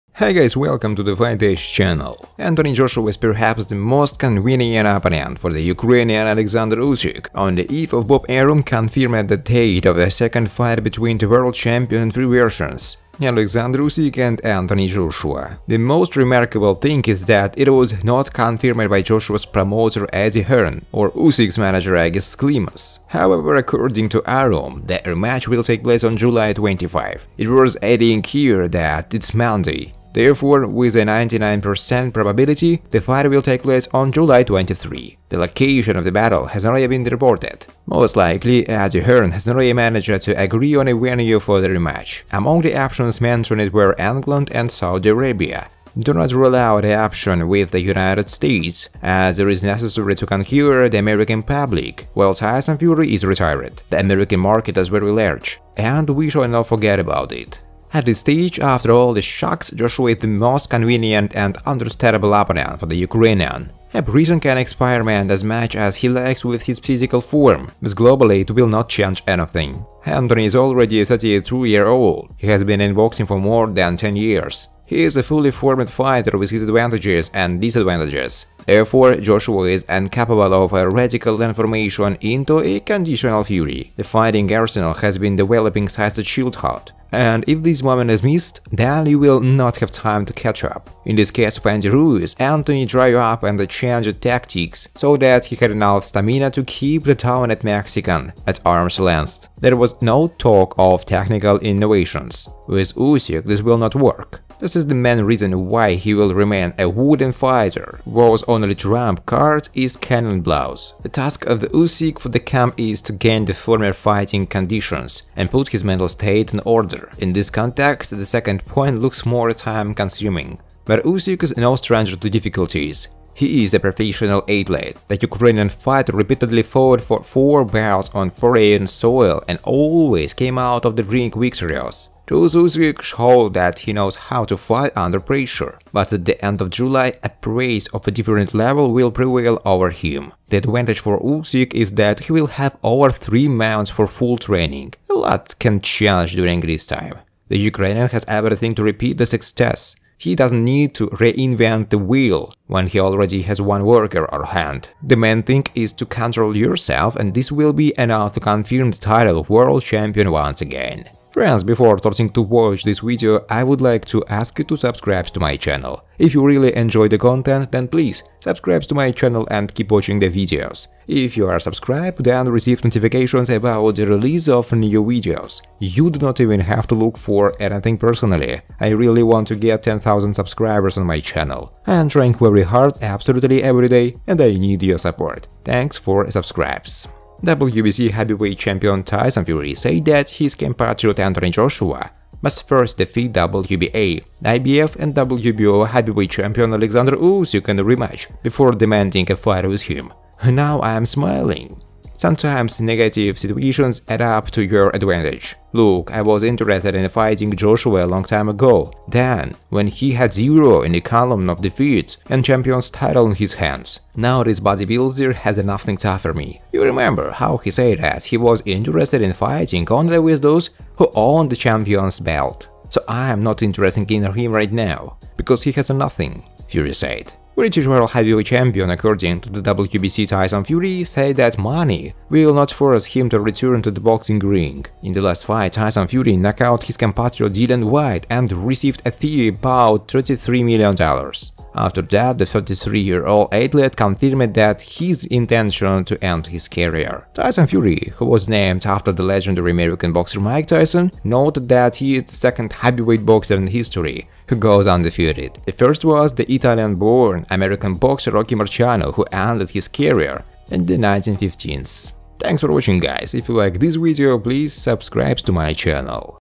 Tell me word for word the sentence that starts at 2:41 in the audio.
Friends, before starting to watch this video, I would like to ask you to subscribe to my channel.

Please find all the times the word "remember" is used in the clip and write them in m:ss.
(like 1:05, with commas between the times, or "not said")
3:36.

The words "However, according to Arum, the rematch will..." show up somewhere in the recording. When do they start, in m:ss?
0:23.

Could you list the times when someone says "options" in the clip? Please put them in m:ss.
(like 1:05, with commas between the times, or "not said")
0:42, 0:46.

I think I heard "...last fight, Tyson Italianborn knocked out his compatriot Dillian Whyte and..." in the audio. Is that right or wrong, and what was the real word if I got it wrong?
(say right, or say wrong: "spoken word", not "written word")
wrong: "Fury", not "Italianborn".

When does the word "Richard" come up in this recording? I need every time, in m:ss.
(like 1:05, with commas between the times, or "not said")
not said.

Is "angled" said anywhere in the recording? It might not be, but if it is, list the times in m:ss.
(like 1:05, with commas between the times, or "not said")
not said.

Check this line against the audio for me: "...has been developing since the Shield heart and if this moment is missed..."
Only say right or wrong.
right.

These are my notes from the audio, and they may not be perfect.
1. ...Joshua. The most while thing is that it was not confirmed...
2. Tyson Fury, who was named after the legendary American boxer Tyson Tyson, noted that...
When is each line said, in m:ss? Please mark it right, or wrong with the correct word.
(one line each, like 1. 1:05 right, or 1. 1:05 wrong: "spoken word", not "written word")
1. 0:14 wrong: "remarkable", not "while"
2. 4:07 wrong: "Mike", not "Tyson".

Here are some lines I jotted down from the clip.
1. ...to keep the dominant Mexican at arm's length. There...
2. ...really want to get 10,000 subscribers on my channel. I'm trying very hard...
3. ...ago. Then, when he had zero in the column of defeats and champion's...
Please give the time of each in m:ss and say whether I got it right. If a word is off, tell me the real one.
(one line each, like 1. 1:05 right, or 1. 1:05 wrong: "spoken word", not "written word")
1. 1:36 right
2. 2:58 right
3. 3:28 right.